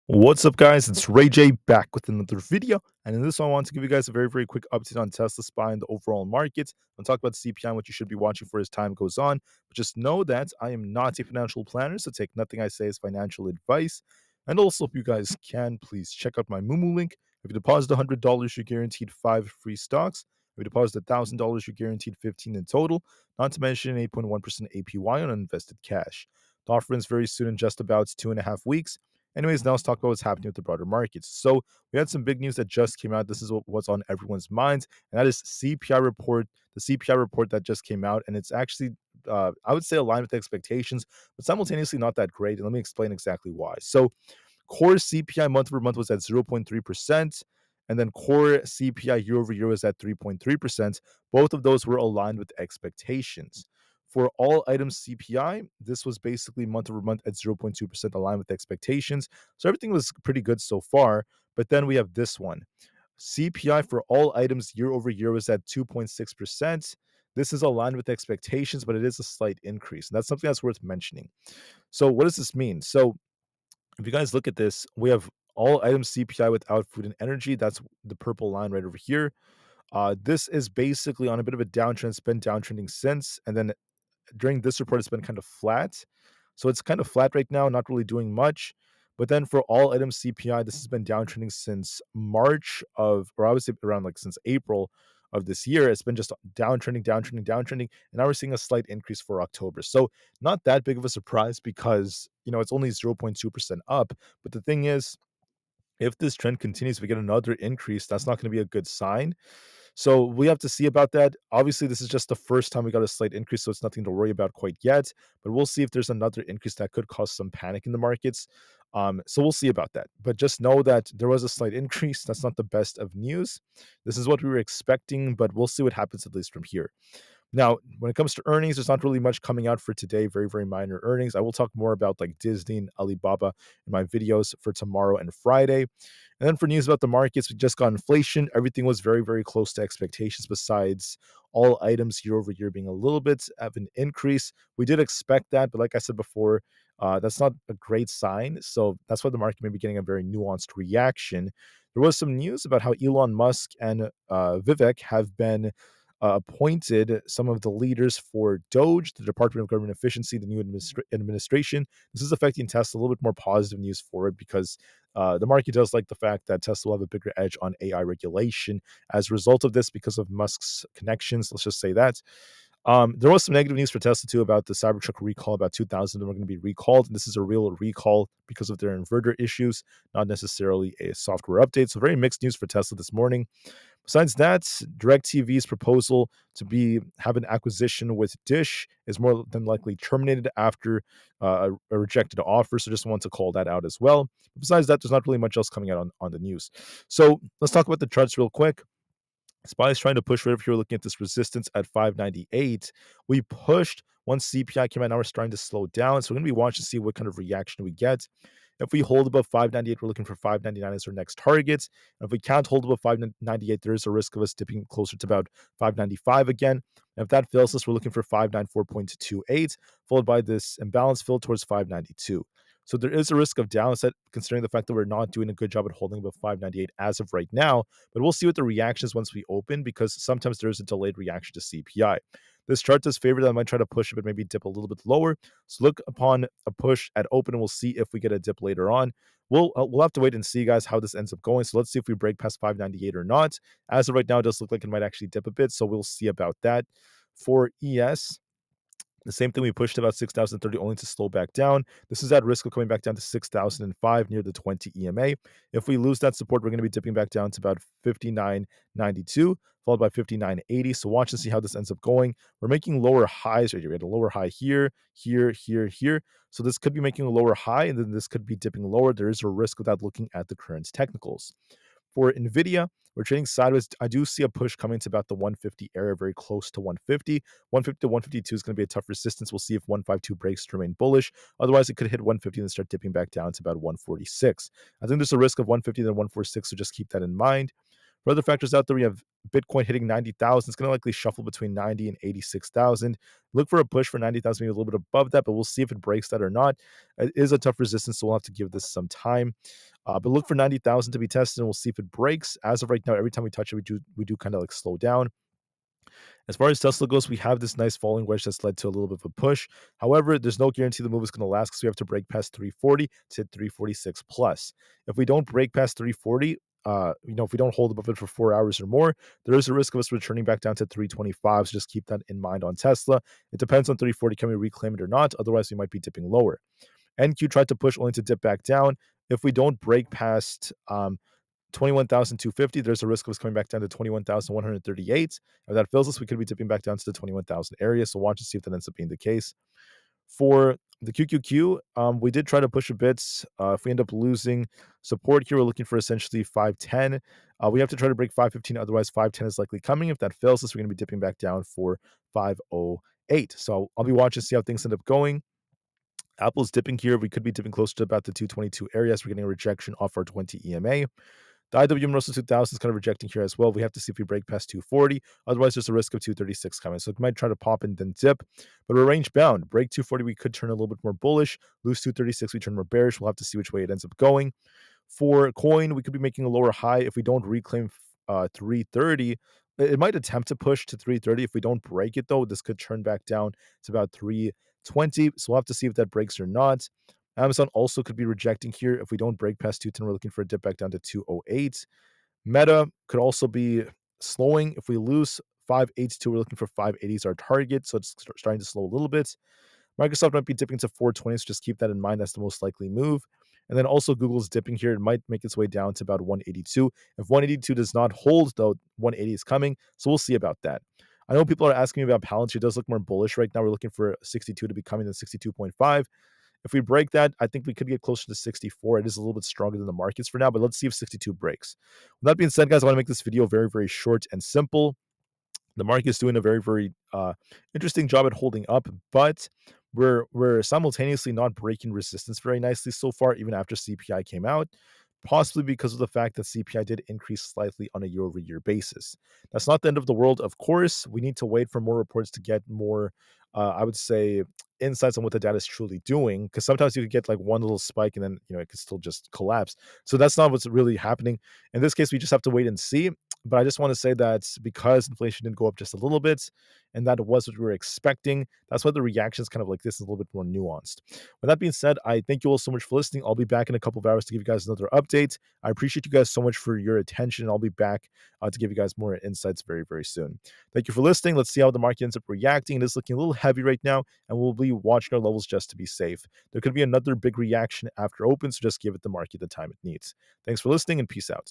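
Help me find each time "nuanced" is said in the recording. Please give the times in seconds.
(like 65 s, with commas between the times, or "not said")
150 s, 460 s.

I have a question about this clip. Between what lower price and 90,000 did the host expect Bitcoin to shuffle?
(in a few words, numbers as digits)
86,000.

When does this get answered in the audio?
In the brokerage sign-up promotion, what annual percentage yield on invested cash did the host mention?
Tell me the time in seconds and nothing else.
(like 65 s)
24 s.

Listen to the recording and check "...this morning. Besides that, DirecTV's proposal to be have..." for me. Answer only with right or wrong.
right.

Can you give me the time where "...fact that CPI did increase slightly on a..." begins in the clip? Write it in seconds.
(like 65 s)
436 s.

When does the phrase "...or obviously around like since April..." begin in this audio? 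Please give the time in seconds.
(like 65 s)
93 s.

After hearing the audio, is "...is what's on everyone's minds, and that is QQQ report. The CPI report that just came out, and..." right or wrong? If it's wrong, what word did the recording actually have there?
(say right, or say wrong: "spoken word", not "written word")
wrong: "CPI", not "QQQ".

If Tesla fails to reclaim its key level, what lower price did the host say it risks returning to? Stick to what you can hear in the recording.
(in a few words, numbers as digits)
325.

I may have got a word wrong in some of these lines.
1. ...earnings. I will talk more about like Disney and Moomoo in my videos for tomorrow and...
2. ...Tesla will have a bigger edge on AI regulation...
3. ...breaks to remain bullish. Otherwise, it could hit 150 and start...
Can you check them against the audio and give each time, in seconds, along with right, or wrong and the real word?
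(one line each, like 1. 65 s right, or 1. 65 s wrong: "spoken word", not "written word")
1. 131 s wrong: "Alibaba", not "Moomoo"
2. 166 s right
3. 280 s right.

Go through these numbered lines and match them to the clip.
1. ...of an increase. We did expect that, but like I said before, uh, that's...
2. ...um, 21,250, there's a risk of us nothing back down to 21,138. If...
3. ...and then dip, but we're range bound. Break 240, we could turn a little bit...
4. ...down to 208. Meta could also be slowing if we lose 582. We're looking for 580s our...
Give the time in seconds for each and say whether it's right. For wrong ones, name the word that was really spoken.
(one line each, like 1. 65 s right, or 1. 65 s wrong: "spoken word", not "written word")
1. 143 s right
2. 330 s wrong: "coming", not "nothing"
3. 367 s right
4. 390 s right.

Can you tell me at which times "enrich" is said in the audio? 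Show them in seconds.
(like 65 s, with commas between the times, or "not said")
not said.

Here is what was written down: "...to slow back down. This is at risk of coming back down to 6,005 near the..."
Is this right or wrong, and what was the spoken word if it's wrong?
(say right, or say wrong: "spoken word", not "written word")
right.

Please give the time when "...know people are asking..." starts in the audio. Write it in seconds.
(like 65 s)
411 s.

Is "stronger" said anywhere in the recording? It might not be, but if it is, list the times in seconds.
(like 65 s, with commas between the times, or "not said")
419 s.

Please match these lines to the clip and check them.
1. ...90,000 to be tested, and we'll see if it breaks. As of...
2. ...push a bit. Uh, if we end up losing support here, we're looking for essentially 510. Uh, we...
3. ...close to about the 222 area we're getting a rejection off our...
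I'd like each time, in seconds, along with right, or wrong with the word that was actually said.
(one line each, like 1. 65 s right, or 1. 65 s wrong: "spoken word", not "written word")
1. 300 s right
2. 342 s right
3. 357 s right.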